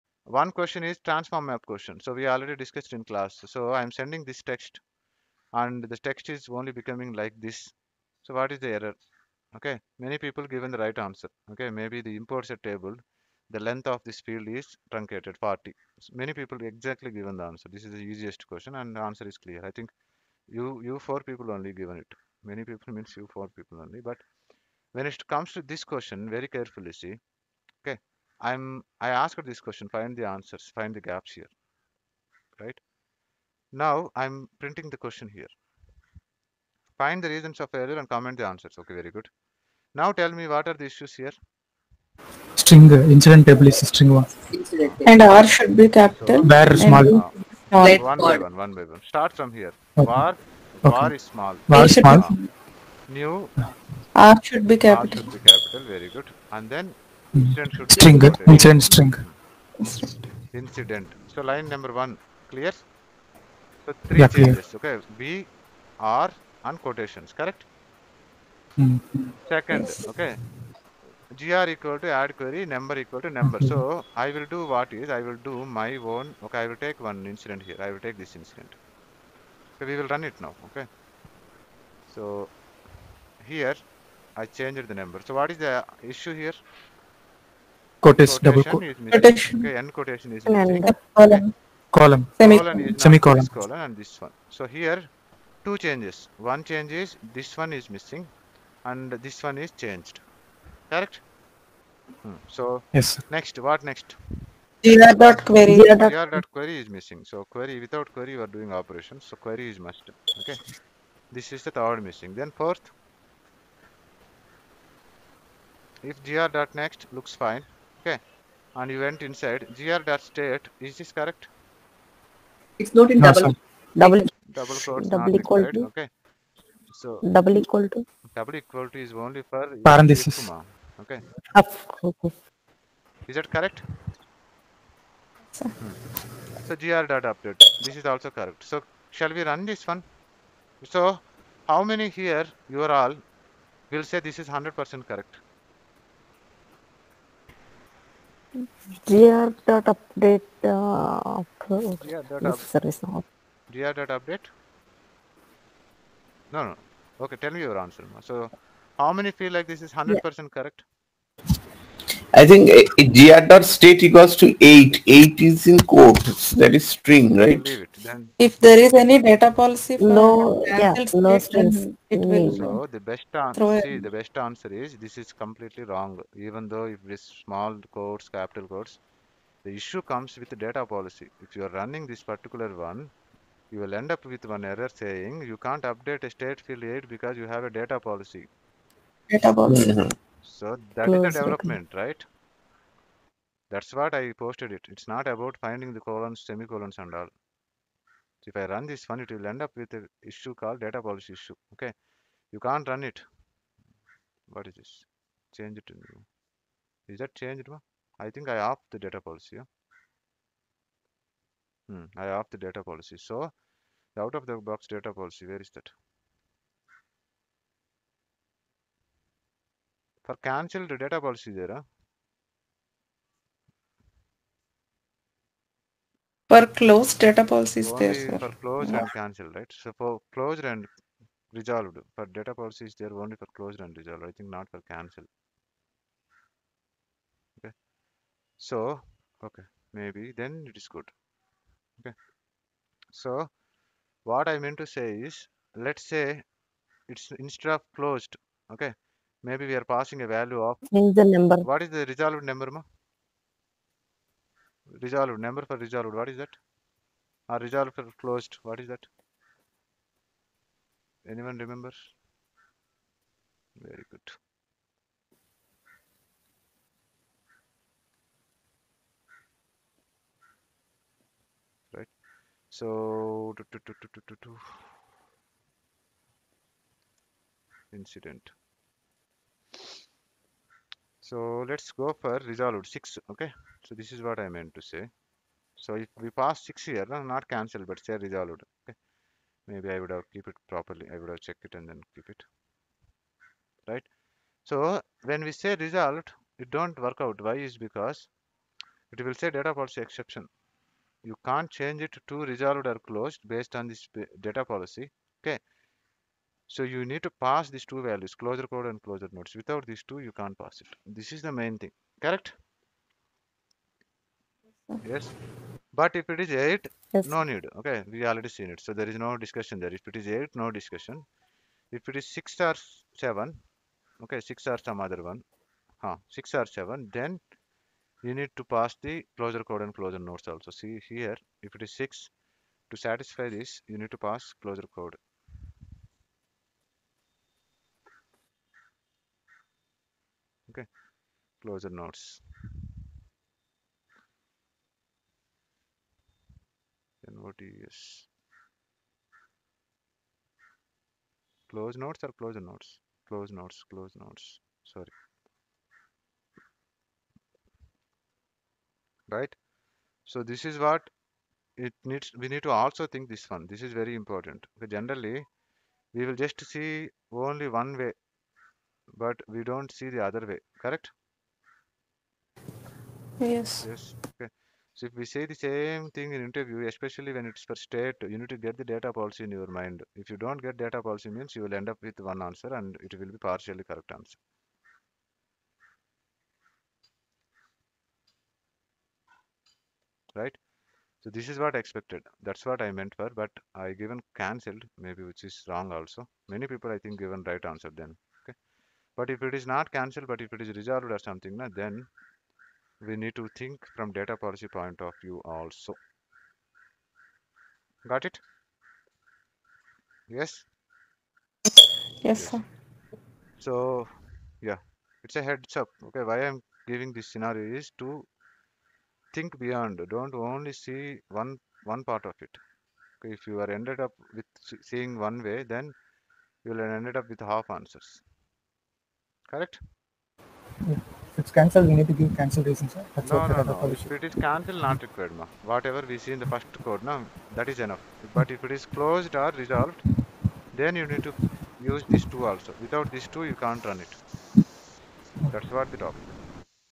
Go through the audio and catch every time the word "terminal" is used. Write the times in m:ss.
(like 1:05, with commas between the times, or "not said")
not said.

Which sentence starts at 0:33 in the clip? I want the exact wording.
Now I'm printing the question here.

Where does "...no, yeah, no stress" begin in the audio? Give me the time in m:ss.
2:50.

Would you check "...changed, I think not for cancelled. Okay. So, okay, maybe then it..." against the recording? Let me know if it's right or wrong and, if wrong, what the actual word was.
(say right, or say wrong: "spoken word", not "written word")
wrong: "resolved", not "changed".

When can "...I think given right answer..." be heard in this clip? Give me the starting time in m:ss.
6:36.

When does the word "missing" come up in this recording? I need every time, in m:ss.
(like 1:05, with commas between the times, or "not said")
1:30, 1:37, 1:46, 1:52.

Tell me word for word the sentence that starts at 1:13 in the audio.
So I will do what is, I will do my own, okay, I will take one incident here.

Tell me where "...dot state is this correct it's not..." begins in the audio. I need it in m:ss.
2:00.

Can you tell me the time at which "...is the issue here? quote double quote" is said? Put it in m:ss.
1:25.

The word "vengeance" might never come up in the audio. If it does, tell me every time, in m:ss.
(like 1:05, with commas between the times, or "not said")
not said.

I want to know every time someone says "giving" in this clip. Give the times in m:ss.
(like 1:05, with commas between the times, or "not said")
6:56.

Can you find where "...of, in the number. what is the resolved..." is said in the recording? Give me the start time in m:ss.
4:10.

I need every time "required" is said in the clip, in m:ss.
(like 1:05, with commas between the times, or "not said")
7:15.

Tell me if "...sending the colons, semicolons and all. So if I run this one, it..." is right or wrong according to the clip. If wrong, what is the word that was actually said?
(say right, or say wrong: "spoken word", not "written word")
wrong: "finding", not "sending".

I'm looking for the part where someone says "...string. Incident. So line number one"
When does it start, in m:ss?
0:58.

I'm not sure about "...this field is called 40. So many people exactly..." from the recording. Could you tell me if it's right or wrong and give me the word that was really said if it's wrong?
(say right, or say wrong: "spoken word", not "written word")
wrong: "truncated", not "called".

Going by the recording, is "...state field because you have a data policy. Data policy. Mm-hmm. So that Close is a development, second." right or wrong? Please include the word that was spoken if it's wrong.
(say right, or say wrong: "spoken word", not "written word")
right.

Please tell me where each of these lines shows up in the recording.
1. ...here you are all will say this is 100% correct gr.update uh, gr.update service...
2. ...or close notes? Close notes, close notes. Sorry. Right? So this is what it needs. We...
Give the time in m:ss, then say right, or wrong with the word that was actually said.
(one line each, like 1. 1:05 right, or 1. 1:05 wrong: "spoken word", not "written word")
1. 2:22 right
2. 5:52 right.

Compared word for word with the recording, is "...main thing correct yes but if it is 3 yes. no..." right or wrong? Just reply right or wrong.
wrong.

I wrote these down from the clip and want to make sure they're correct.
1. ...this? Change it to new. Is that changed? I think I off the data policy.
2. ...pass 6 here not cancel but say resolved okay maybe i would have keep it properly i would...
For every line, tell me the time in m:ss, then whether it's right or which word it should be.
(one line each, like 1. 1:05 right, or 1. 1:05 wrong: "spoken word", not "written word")
1. 3:24 right
2. 4:46 right.